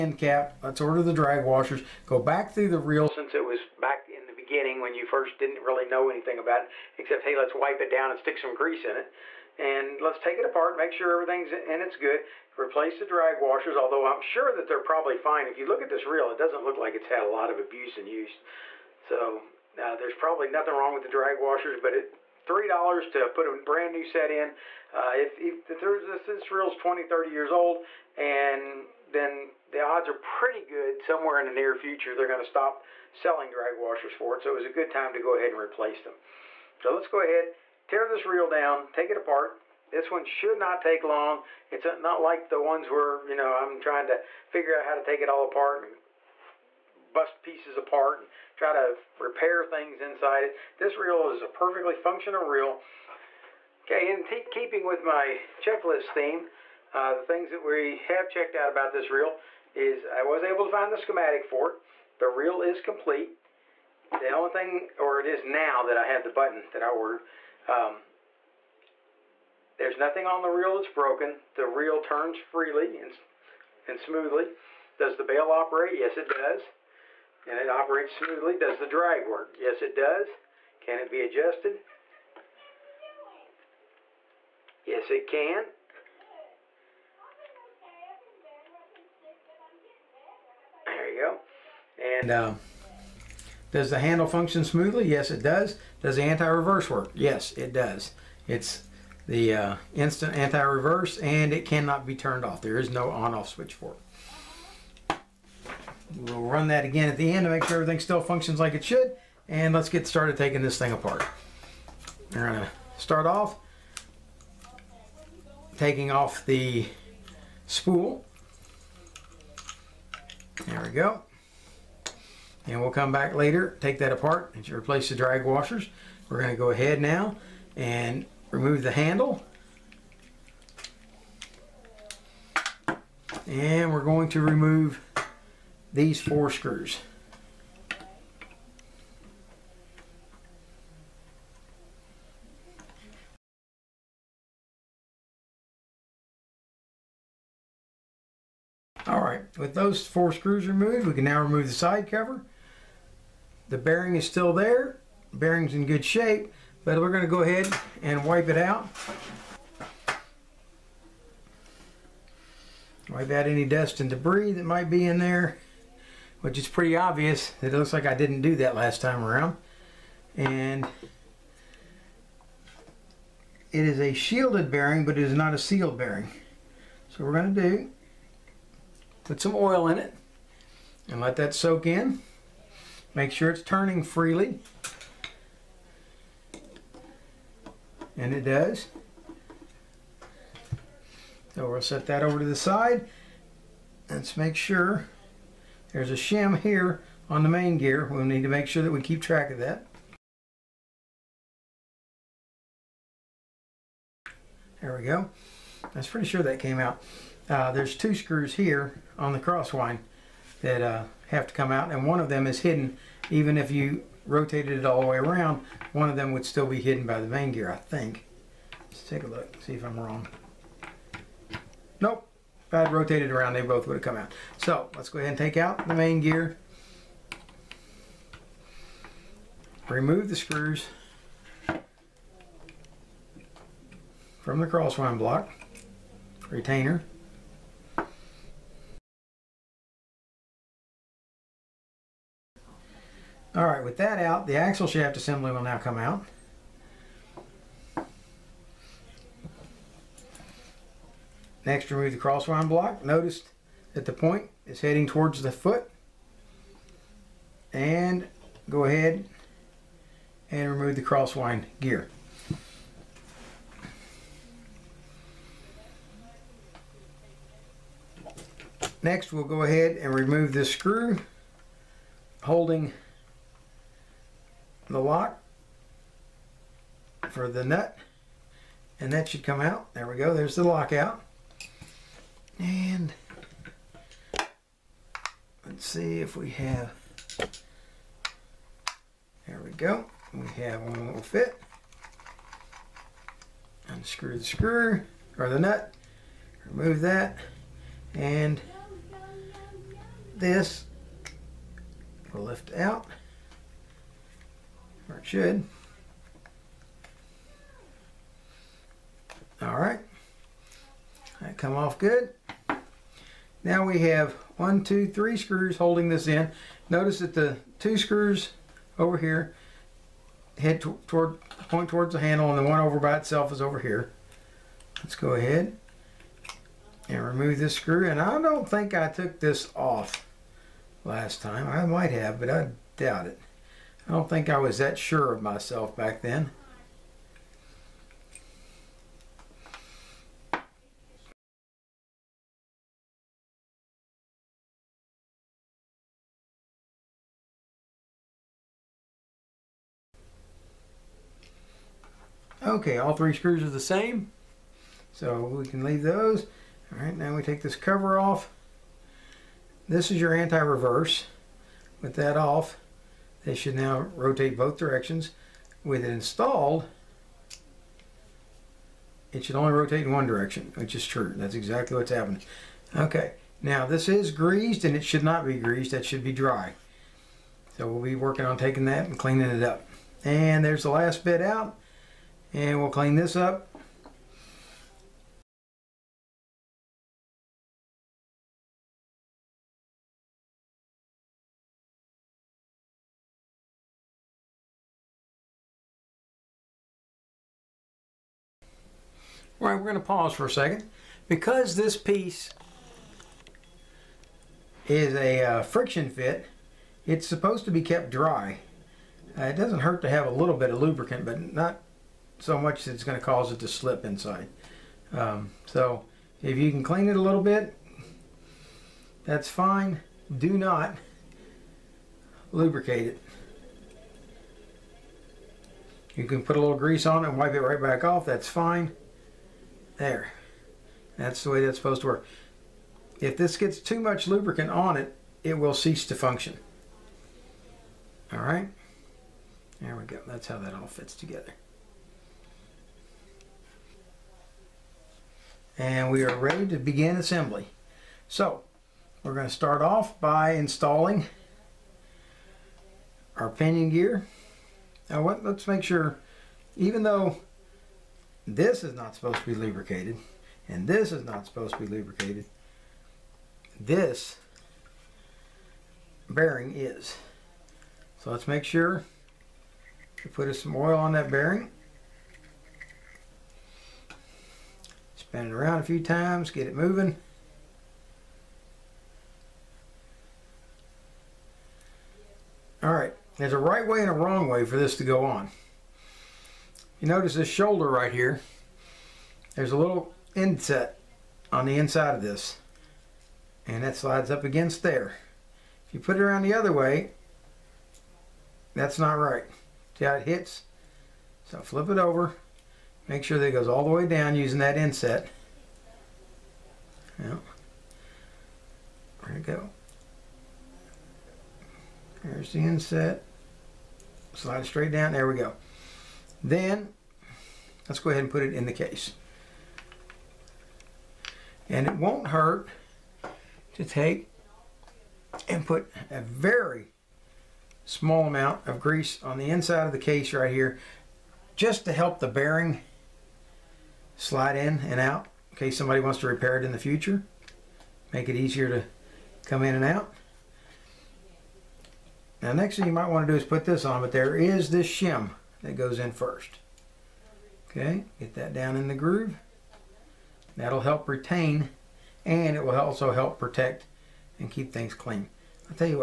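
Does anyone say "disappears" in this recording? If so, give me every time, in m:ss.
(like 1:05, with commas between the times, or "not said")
not said.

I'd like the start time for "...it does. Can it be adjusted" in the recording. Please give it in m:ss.
1:19.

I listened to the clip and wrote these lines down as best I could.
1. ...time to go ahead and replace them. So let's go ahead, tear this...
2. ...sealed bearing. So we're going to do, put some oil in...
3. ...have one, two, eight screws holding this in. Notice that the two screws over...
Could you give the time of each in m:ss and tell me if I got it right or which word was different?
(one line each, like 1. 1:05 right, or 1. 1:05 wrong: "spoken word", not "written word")
1. 0:34 right
2. 2:55 right
3. 5:13 wrong: "three", not "eight".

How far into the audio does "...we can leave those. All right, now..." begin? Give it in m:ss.
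5:55.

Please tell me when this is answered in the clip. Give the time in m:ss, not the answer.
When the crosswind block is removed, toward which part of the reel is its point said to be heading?
4:15.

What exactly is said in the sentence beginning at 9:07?
Okay, get that down in the groove.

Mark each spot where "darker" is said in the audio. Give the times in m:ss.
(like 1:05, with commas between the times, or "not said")
not said.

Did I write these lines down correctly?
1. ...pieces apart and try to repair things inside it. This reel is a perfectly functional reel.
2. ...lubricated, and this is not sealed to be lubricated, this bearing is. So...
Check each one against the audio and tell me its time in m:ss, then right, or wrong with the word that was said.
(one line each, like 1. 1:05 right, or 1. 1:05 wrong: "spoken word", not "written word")
1. 0:47 right
2. 7:39 wrong: "supposed", not "sealed".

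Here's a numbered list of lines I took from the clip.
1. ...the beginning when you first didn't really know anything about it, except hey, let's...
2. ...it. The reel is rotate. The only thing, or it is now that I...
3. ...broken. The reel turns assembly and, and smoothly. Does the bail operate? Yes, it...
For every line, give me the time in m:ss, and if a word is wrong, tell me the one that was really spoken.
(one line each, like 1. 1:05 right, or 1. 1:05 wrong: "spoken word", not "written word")
1. 0:04 right
2. 1:01 wrong: "complete", not "rotate"
3. 1:10 wrong: "freely", not "assembly".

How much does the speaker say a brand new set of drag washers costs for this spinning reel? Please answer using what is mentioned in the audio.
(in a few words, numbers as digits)
$3.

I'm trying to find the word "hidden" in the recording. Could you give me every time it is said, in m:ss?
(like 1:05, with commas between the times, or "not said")
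3:32, 3:36.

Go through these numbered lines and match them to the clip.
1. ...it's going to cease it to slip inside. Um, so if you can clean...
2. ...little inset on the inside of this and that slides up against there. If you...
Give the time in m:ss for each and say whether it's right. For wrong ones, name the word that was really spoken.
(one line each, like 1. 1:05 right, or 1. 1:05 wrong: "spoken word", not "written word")
1. 6:52 wrong: "cause", not "cease"
2. 8:09 right.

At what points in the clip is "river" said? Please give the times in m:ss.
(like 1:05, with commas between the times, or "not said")
not said.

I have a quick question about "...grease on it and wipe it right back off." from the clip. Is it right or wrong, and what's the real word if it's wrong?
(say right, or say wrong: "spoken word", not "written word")
right.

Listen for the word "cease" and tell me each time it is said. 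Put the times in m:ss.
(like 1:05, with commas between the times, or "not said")
7:15.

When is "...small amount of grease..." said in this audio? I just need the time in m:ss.
8:47.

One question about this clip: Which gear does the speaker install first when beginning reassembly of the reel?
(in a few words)
Pinion gear.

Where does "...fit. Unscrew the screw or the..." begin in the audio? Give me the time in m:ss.
4:51.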